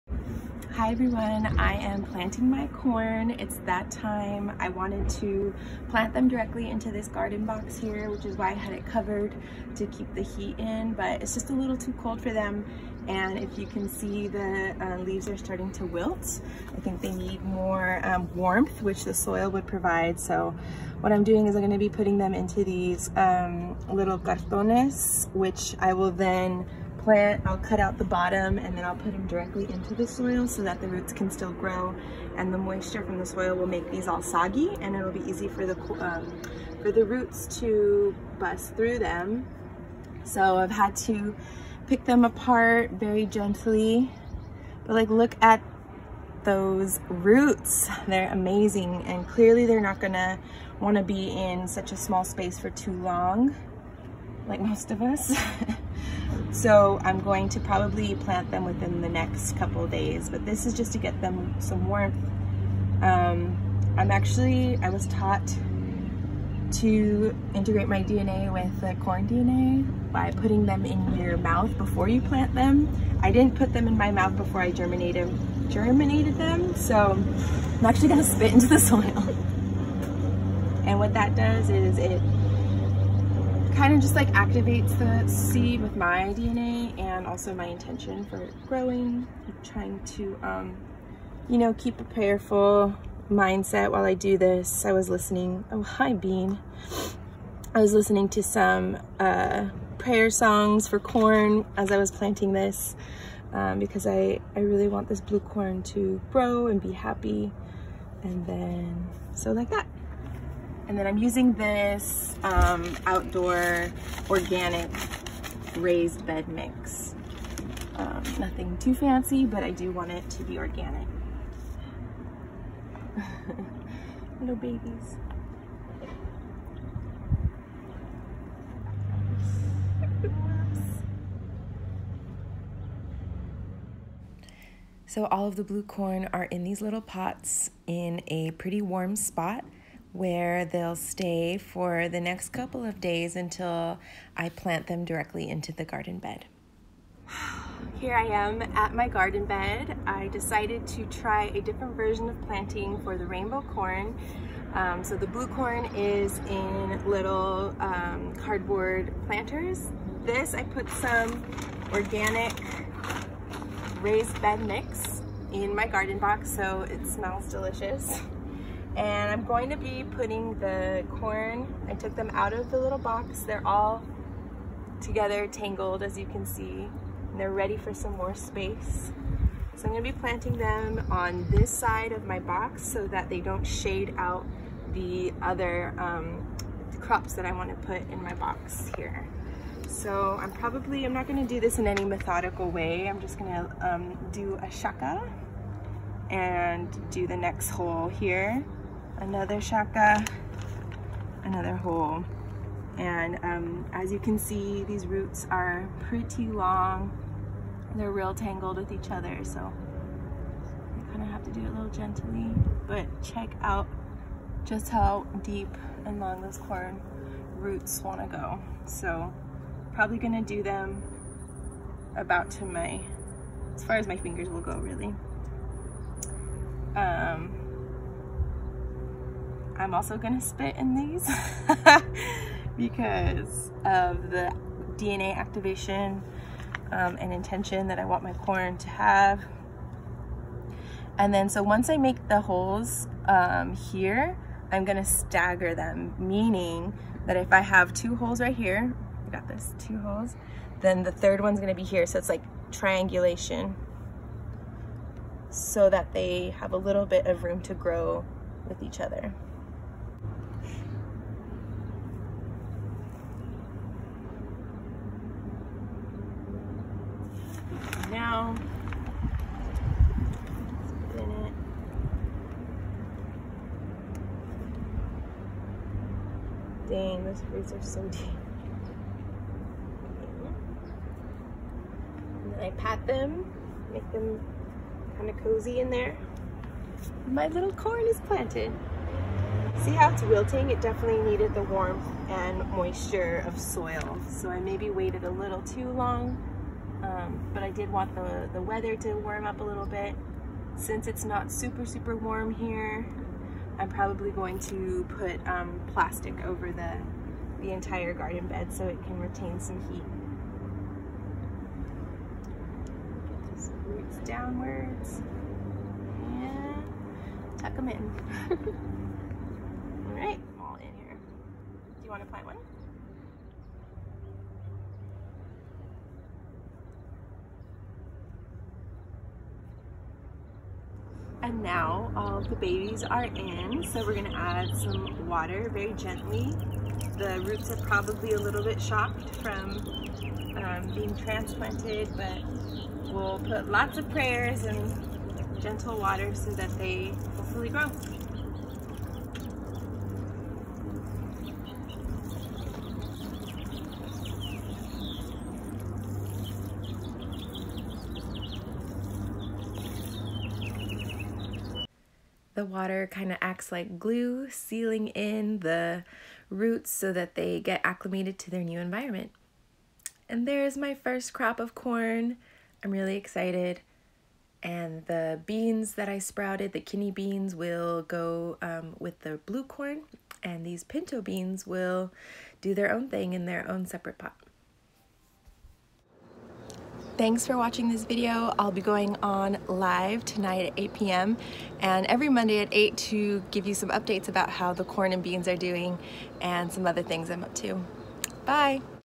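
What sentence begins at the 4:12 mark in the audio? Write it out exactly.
So it's like triangulation so that they have a little bit of room to grow with each other.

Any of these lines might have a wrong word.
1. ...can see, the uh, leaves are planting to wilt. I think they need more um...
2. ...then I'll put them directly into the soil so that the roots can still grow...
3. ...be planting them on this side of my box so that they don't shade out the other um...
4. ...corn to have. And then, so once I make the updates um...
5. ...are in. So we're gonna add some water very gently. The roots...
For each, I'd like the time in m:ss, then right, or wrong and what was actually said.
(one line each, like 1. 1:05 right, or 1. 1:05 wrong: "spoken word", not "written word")
1. 0:13 wrong: "starting", not "planting"
2. 0:28 right
3. 3:00 right
4. 3:58 wrong: "holes", not "updates"
5. 5:33 right.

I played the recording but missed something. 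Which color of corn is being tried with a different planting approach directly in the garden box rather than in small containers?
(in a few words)
rainbow.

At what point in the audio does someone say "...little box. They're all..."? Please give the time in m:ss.
2:52.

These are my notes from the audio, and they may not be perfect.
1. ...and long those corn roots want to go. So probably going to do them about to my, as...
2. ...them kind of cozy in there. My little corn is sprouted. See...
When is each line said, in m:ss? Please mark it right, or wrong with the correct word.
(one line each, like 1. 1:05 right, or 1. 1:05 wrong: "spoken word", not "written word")
1. 3:36 right
2. 4:44 wrong: "planted", not "sprouted".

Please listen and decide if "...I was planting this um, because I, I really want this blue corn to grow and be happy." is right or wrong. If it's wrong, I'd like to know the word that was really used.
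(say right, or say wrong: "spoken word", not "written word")
right.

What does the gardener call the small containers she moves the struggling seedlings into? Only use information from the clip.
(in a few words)
cartones.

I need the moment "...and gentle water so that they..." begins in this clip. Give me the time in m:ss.
5:44.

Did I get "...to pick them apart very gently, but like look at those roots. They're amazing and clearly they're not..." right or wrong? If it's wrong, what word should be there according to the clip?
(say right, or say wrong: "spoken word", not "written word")
right.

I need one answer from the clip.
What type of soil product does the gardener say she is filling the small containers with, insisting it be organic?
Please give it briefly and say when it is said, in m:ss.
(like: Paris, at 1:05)
outdoor organic raised bed mix, at 1:53.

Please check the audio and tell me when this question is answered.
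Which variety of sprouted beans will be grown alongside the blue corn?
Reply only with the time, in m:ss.
6:16.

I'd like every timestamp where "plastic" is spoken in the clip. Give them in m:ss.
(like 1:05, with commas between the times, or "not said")
5:05.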